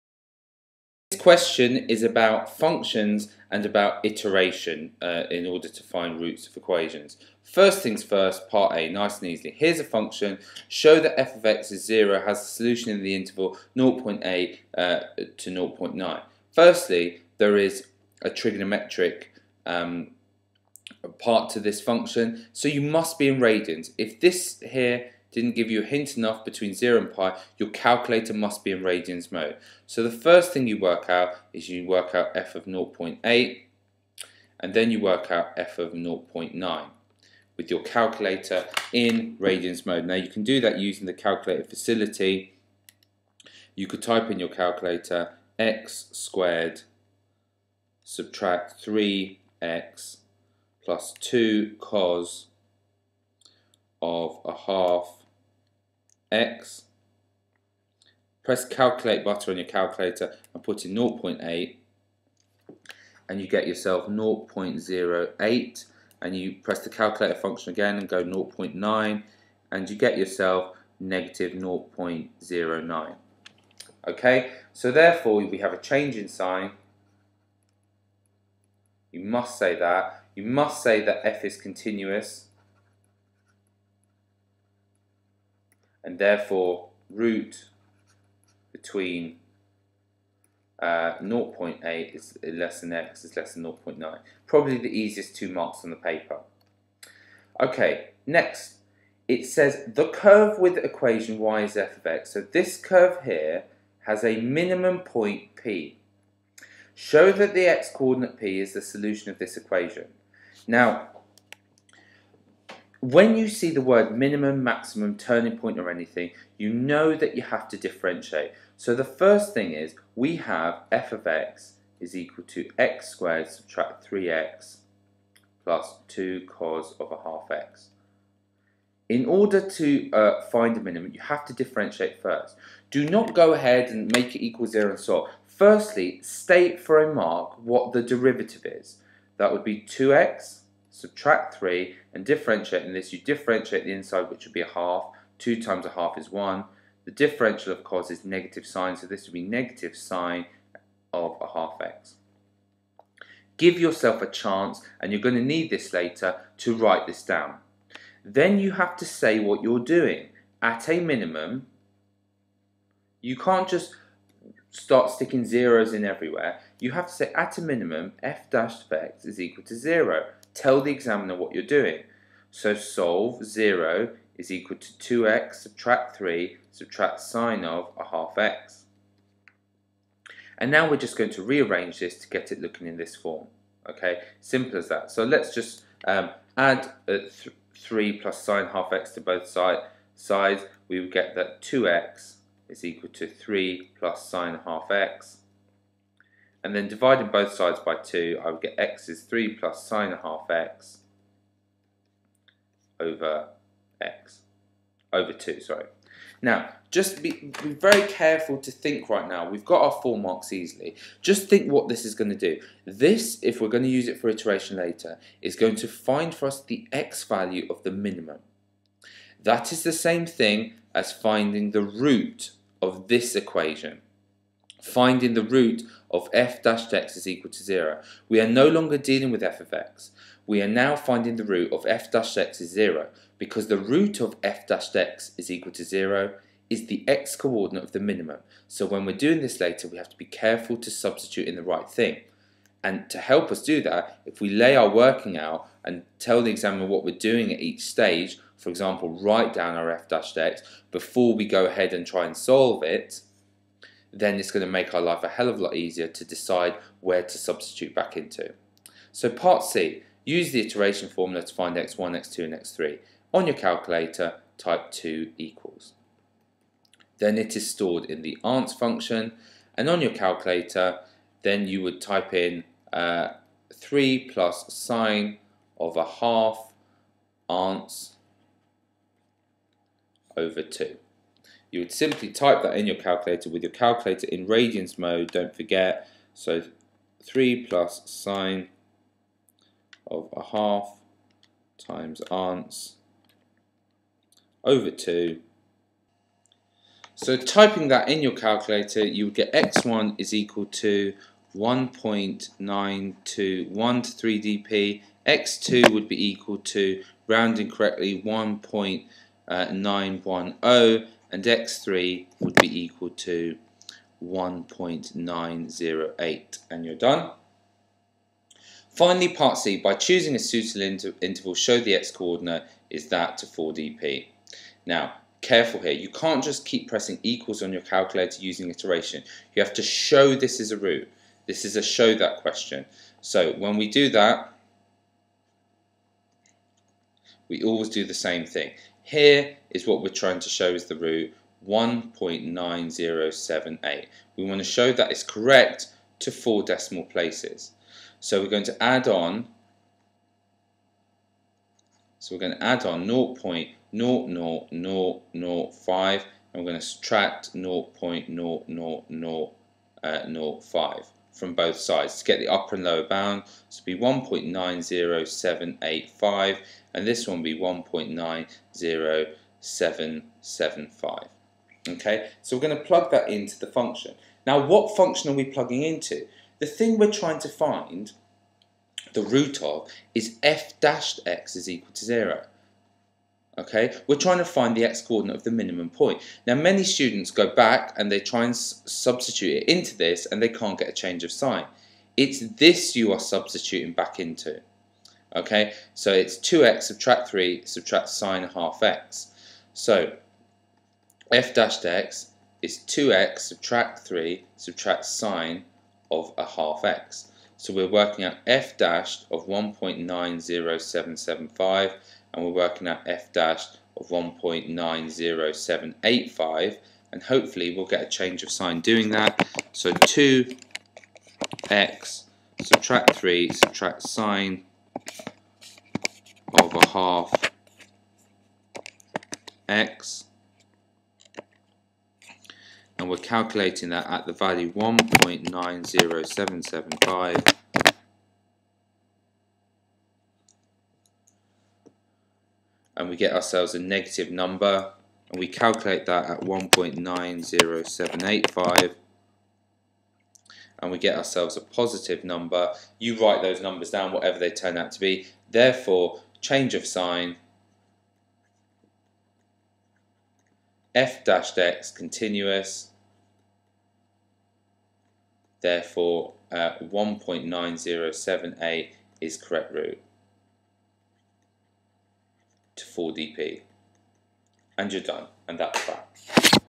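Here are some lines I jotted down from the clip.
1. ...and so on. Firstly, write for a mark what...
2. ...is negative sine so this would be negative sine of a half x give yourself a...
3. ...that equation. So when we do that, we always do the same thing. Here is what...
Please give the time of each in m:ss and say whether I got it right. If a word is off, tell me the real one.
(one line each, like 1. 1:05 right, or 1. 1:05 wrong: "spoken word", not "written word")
1. 2:14 wrong: "state", not "write"
2. 2:28 right
3. 5:32 wrong: "question", not "equation".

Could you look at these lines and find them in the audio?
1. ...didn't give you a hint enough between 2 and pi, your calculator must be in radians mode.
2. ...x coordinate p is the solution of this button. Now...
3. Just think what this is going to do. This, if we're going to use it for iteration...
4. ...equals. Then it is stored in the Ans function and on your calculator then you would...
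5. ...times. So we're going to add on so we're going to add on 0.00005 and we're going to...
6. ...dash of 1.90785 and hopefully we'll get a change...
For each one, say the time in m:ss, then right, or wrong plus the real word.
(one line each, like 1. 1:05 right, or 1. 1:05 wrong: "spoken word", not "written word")
1. 0:25 wrong: "0", not "2"
2. 1:47 wrong: "equation", not "button"
3. 3:31 right
4. 4:25 right
5. 5:47 wrong: "places", not "times"
6. 6:53 right.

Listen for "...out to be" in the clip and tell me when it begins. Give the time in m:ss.
7:34.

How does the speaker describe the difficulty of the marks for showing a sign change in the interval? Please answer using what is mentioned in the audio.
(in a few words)
easiest two marks.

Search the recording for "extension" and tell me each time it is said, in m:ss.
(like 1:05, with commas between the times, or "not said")
not said.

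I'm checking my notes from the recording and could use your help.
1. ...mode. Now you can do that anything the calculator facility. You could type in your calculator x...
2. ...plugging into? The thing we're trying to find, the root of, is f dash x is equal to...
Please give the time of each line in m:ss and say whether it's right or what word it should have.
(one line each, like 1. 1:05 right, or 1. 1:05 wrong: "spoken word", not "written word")
1. 0:39 wrong: "using", not "anything"
2. 6:15 right.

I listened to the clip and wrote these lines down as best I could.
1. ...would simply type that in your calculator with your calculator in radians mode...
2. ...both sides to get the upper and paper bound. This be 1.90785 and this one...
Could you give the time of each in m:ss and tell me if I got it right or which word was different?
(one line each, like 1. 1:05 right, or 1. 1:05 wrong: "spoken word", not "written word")
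1. 4:41 right
2. 6:01 wrong: "lower", not "paper".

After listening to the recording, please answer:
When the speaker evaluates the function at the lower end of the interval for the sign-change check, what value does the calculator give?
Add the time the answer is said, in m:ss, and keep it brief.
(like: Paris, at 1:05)
0.08, at 1:04.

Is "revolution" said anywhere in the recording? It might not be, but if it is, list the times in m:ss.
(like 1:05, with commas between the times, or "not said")
not said.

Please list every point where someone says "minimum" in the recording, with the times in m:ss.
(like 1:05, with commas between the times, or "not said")
1:44, 1:54, 2:10, 2:40, 2:47, 3:37, 3:57, 6:25.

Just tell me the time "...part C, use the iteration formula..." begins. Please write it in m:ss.
4:19.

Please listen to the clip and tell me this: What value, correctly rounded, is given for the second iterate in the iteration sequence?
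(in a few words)
1.910.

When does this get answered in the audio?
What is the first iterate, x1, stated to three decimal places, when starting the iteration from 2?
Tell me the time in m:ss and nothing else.
5:01.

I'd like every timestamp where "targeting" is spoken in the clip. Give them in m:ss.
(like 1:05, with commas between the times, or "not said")
not said.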